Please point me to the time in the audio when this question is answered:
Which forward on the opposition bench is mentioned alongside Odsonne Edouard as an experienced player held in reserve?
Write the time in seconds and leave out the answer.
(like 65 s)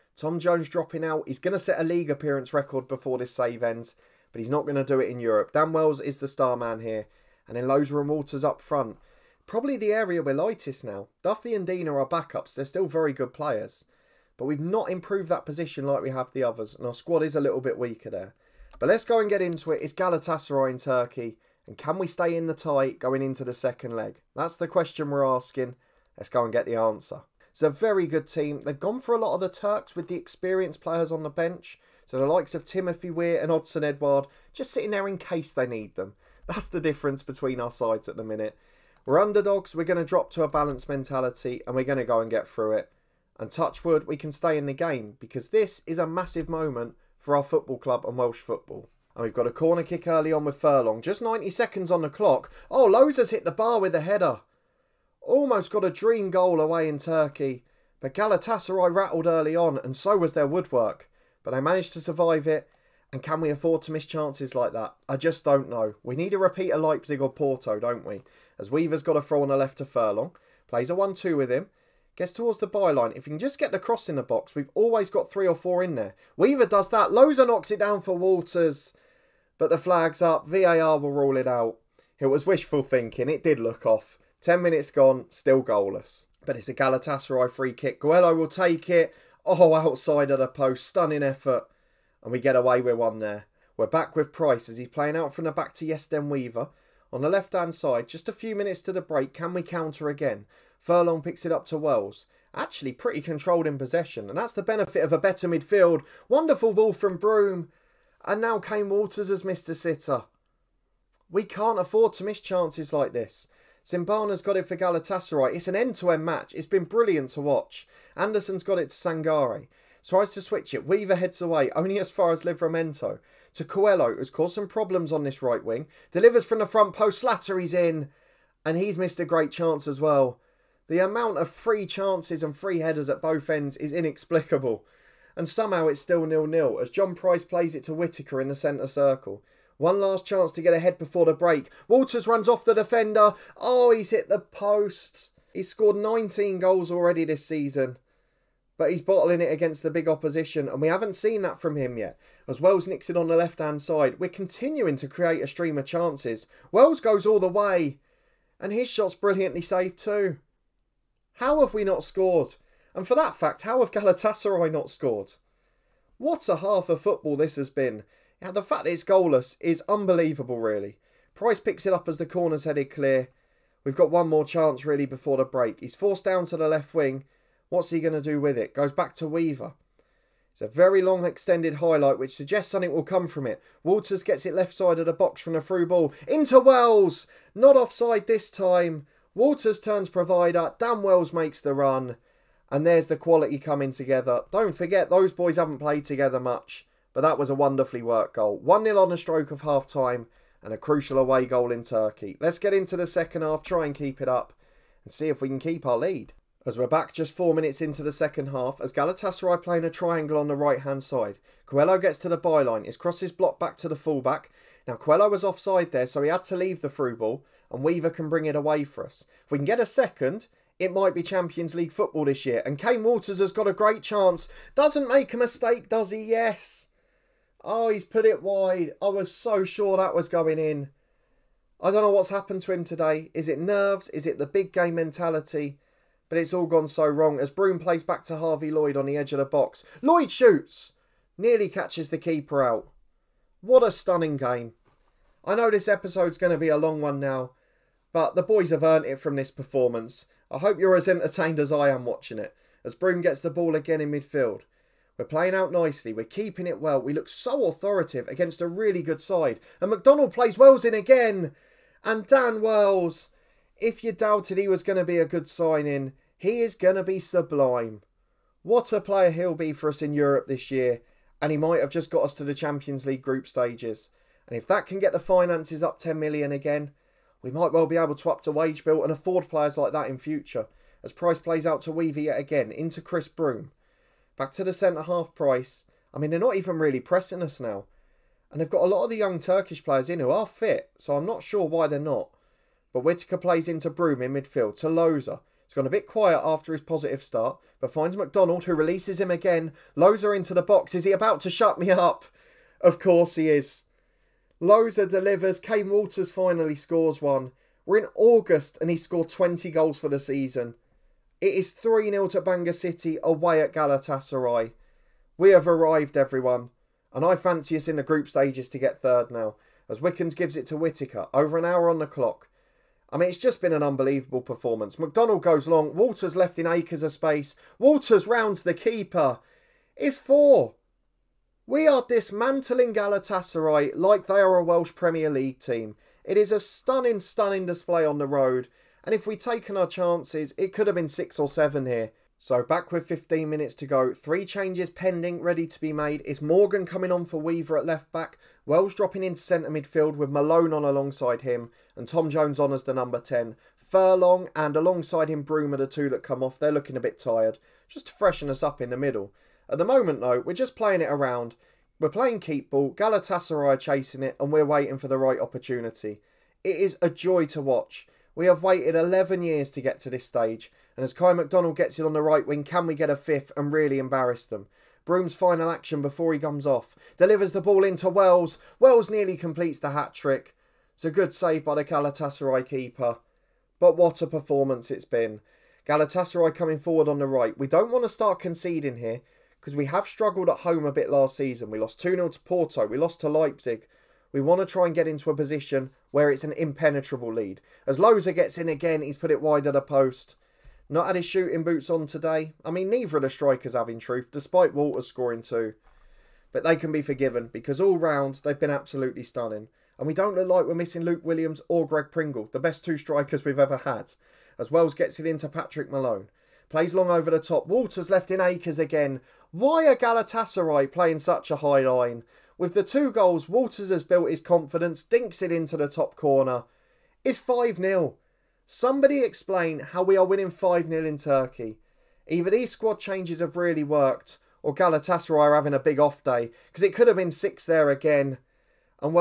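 32 s.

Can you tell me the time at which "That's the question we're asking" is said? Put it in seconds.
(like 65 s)
24 s.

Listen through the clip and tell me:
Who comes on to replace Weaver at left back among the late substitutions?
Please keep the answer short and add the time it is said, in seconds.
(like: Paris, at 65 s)
Morgan, at 346 s.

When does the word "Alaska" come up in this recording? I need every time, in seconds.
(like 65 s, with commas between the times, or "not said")
not said.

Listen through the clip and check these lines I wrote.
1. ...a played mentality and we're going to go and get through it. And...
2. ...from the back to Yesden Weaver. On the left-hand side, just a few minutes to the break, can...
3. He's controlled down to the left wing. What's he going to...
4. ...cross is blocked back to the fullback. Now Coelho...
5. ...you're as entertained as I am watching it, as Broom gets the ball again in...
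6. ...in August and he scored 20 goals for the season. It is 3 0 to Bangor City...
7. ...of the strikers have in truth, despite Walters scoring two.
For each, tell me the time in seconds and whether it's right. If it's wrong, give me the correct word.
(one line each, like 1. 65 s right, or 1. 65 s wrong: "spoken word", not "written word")
1. 40 s wrong: "balanced", not "played"
2. 95 s right
3. 175 s wrong: "forced", not "controlled"
4. 212 s right
5. 250 s right
6. 307 s right
7. 403 s right.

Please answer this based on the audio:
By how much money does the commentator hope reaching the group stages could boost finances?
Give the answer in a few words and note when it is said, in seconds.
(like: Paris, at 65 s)
10 million, at 275 s.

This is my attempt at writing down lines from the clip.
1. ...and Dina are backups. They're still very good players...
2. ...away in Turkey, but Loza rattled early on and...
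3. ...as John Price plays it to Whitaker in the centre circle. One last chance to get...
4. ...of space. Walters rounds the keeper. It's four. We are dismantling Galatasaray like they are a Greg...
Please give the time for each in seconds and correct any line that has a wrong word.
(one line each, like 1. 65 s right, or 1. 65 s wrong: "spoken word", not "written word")
1. 11 s right
2. 56 s wrong: "Galatasaray", not "Loza"
3. 136 s right
4. 327 s wrong: "Welsh", not "Greg".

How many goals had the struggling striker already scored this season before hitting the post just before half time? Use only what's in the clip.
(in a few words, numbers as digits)
19.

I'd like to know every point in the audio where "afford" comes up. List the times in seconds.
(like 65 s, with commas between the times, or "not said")
63 s, 111 s, 279 s.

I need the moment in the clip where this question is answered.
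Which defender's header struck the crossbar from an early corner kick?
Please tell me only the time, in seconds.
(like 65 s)
52 s.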